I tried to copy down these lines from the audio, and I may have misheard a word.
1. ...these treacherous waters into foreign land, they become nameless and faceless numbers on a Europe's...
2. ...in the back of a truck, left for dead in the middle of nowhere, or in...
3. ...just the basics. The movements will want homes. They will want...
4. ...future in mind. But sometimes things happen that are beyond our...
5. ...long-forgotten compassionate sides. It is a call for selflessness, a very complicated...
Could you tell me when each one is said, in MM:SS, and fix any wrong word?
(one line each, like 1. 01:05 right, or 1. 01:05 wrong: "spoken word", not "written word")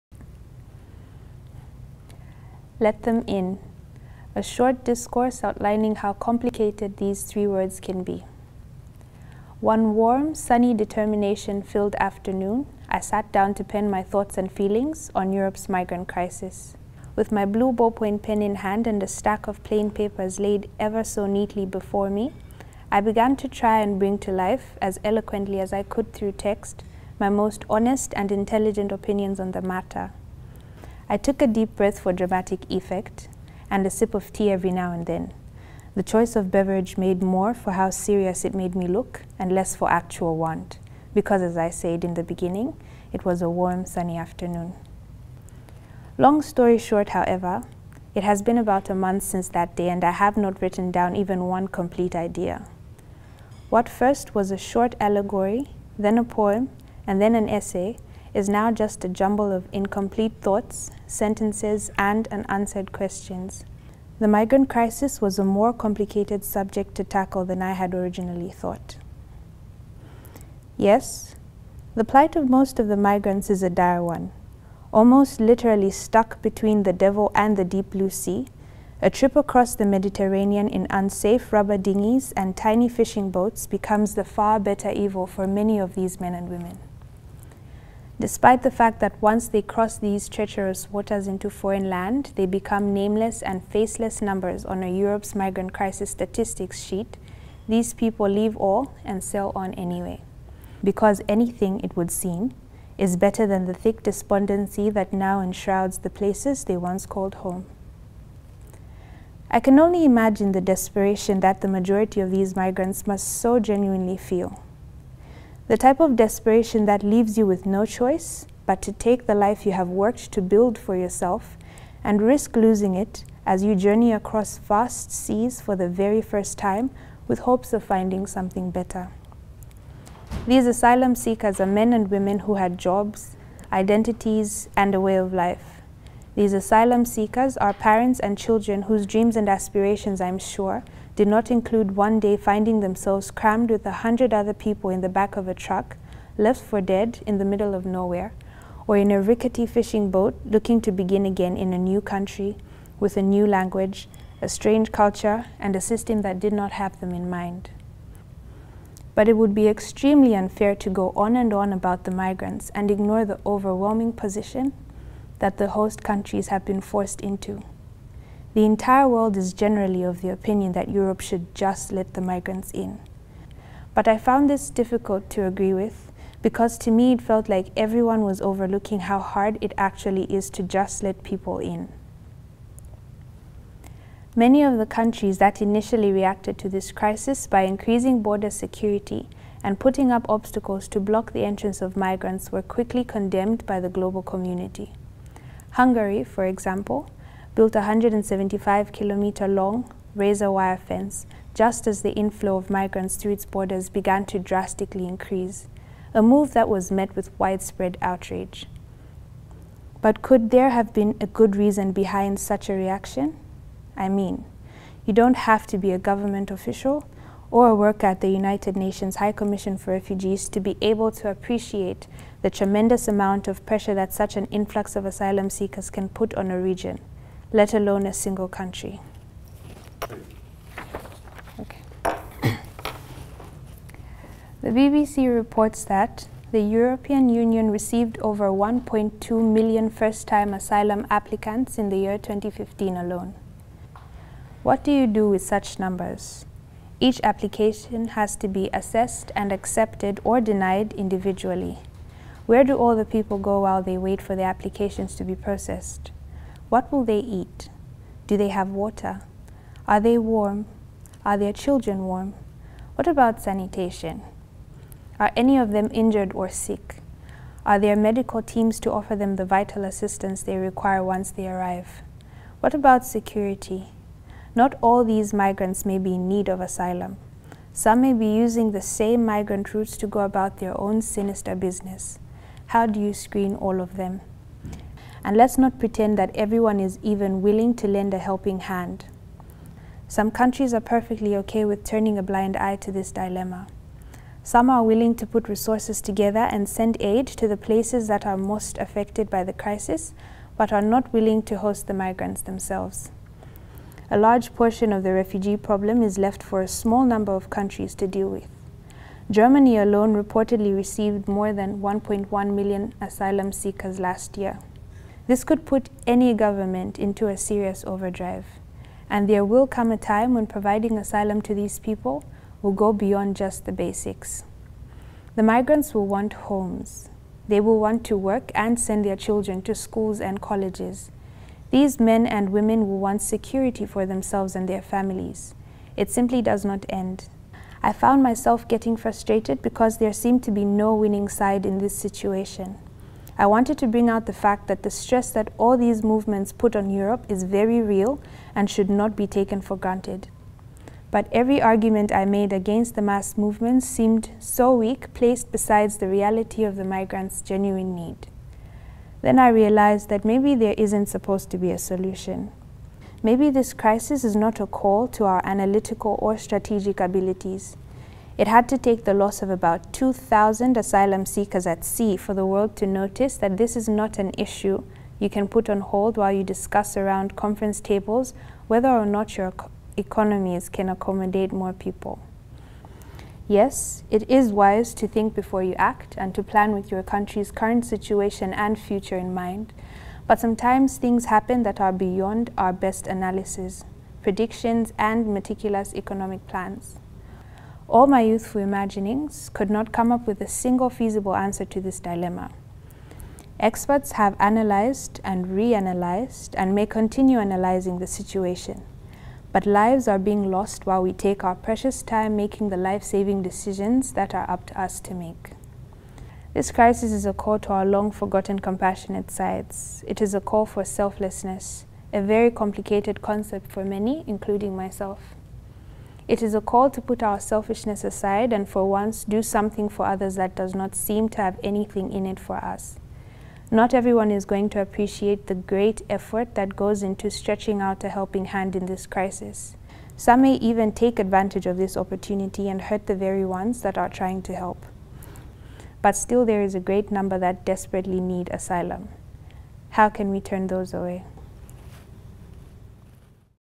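1. 01:29 right
2. 02:24 right
3. 05:23 wrong: "migrants", not "movements"
4. 06:28 right
5. 06:57 right.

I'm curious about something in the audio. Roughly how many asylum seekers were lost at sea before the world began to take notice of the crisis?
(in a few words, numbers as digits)
About 2,000.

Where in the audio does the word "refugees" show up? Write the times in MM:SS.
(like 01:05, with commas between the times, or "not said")
03:39, 05:05.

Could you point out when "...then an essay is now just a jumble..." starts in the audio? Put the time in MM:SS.
00:57.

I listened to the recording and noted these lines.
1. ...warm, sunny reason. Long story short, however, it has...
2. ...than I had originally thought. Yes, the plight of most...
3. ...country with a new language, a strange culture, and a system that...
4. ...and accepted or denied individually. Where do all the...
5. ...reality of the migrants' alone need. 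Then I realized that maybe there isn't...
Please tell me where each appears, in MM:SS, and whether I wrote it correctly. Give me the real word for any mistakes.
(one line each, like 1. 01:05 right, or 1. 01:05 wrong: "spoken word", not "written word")
1. 00:43 wrong: "afternoon", not "reason"
2. 01:07 right
3. 02:32 right
4. 04:09 right
5. 05:56 wrong: "genuine", not "alone".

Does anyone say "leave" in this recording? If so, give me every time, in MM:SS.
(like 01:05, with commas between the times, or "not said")
01:38, 01:57.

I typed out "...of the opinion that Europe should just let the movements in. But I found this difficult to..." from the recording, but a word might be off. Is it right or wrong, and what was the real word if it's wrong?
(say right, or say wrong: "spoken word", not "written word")
wrong: "migrants", not "movements".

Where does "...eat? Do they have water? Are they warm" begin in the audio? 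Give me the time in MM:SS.
04:17.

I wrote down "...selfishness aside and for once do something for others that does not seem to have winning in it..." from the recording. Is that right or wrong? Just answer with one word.
wrong.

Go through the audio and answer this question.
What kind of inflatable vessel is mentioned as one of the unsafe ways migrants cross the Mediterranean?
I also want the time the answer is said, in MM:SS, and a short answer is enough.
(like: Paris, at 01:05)
Rubber dinghies, at 01:21.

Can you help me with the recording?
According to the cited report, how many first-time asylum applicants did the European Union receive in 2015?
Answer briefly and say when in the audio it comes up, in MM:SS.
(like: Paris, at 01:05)
Over 1.2 million, at 03:58.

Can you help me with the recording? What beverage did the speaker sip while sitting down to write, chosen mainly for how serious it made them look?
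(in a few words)
Tea.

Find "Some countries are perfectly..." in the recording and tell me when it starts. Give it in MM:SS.
04:50.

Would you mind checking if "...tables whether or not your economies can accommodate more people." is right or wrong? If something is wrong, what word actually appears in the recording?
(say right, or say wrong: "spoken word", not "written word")
right.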